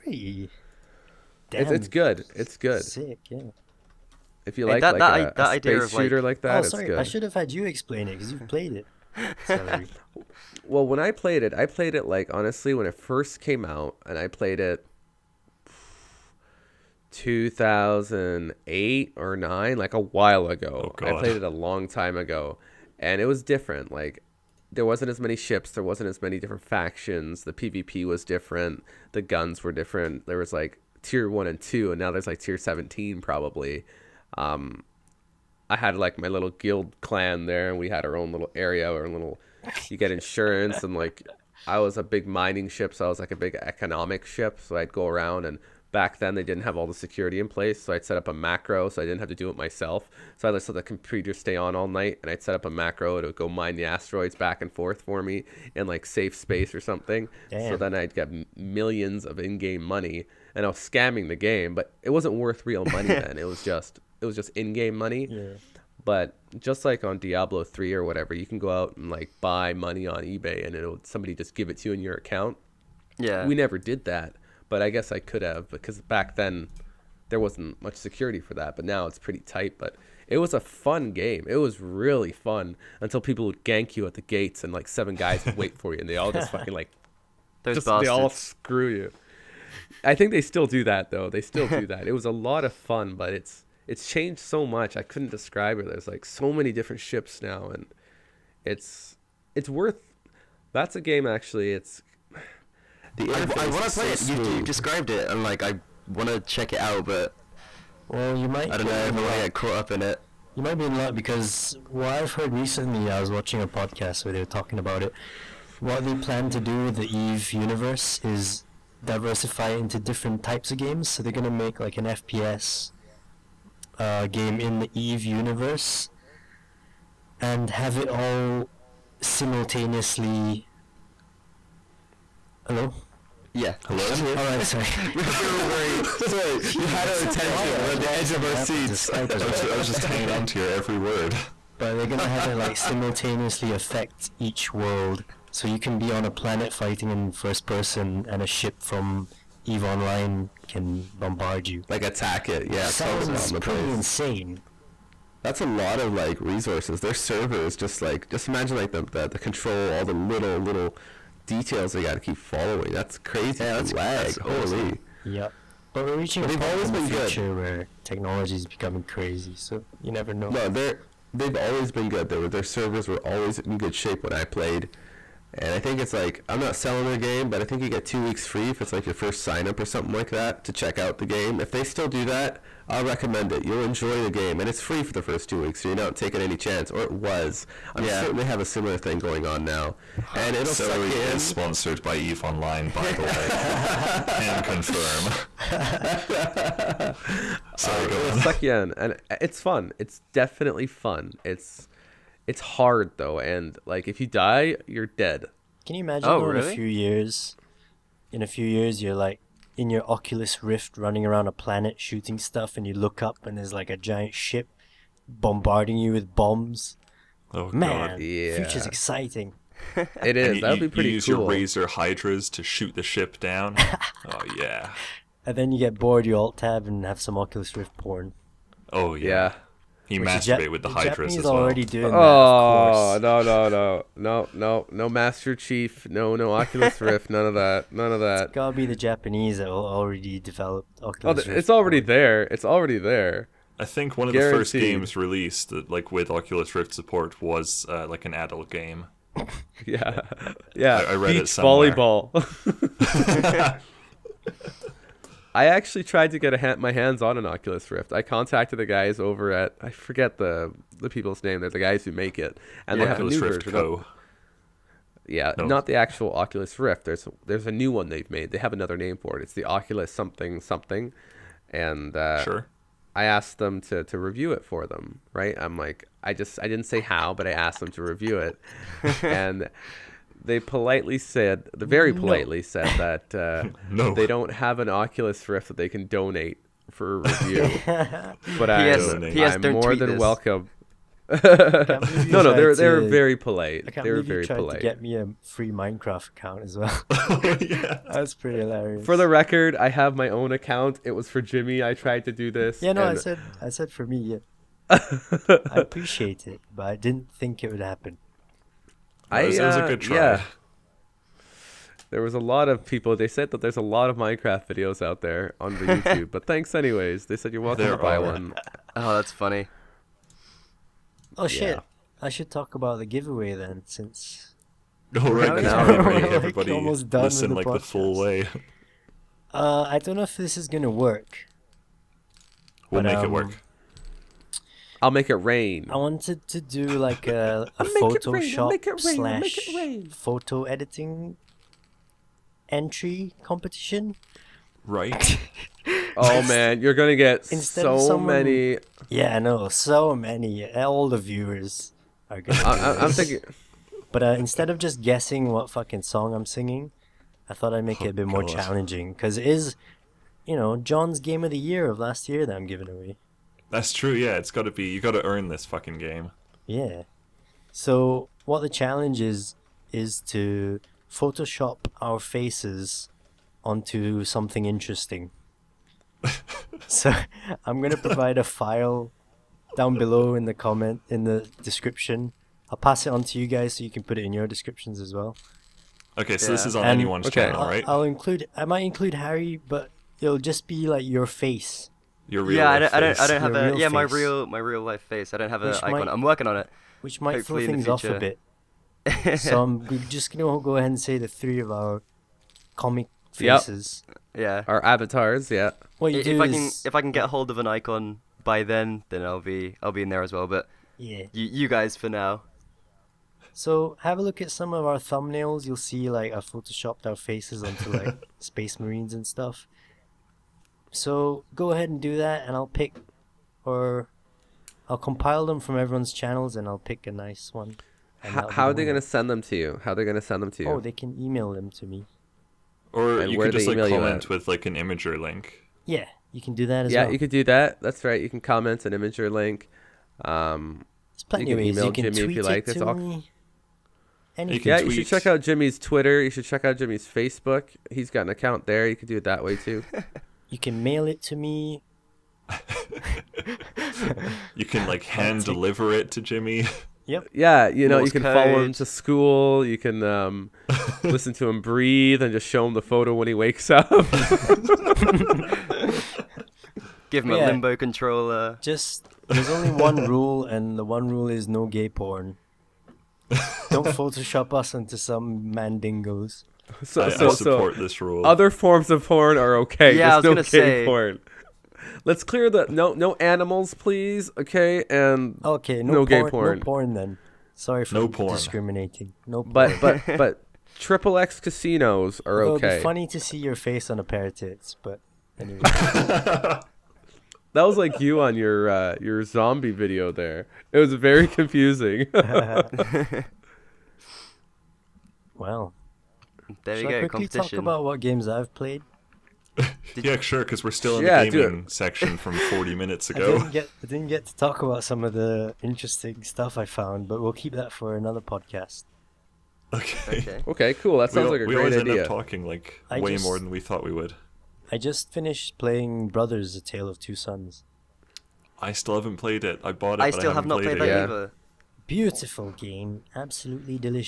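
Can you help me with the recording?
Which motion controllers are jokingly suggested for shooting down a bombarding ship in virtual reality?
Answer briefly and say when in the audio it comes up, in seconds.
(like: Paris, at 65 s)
Razer Hydras, at 221 s.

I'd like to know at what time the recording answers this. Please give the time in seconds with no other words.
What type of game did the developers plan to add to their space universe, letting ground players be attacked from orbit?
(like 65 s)
122 s.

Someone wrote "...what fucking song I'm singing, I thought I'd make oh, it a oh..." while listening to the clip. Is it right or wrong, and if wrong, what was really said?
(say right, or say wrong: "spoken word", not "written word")
right.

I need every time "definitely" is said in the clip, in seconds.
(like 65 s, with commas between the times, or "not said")
200 s.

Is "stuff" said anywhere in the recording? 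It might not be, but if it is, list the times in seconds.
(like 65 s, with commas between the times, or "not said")
212 s, 419 s, 516 s.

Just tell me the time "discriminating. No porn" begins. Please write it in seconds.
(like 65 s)
488 s.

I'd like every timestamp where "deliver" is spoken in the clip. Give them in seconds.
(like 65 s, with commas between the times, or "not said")
455 s.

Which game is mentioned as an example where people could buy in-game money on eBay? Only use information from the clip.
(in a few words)
Diablo 3.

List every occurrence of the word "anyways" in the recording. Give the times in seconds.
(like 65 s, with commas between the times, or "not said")
316 s, 495 s.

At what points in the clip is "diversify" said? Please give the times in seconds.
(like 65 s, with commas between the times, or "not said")
119 s.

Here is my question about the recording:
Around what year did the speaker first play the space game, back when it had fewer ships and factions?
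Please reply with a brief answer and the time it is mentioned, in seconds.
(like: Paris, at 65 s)
2008, at 17 s.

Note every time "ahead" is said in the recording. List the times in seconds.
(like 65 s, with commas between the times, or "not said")
400 s, 421 s.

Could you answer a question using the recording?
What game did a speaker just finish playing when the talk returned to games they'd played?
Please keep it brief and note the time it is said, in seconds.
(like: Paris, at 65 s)
Brothers: A Tale of Two Sons, at 526 s.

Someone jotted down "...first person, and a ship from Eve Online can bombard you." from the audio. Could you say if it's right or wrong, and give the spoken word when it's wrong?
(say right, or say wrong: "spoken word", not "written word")
right.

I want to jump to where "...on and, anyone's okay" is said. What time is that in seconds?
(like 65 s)
386 s.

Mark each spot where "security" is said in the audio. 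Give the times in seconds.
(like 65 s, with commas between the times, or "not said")
46 s, 77 s.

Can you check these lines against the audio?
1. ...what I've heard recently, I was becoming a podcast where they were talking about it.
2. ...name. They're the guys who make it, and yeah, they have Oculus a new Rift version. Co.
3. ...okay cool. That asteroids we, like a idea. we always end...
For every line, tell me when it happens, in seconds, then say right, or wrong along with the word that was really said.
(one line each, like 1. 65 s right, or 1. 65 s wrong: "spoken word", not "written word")
1. 111 s wrong: "watching", not "becoming"
2. 261 s right
3. 520 s wrong: "sounds", not "asteroids".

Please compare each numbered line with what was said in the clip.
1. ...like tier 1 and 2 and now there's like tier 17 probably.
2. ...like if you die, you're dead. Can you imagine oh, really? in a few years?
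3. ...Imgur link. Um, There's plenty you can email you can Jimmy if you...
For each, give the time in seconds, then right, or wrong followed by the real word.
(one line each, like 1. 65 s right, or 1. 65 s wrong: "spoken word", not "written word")
1. 30 s right
2. 203 s right
3. 438 s right.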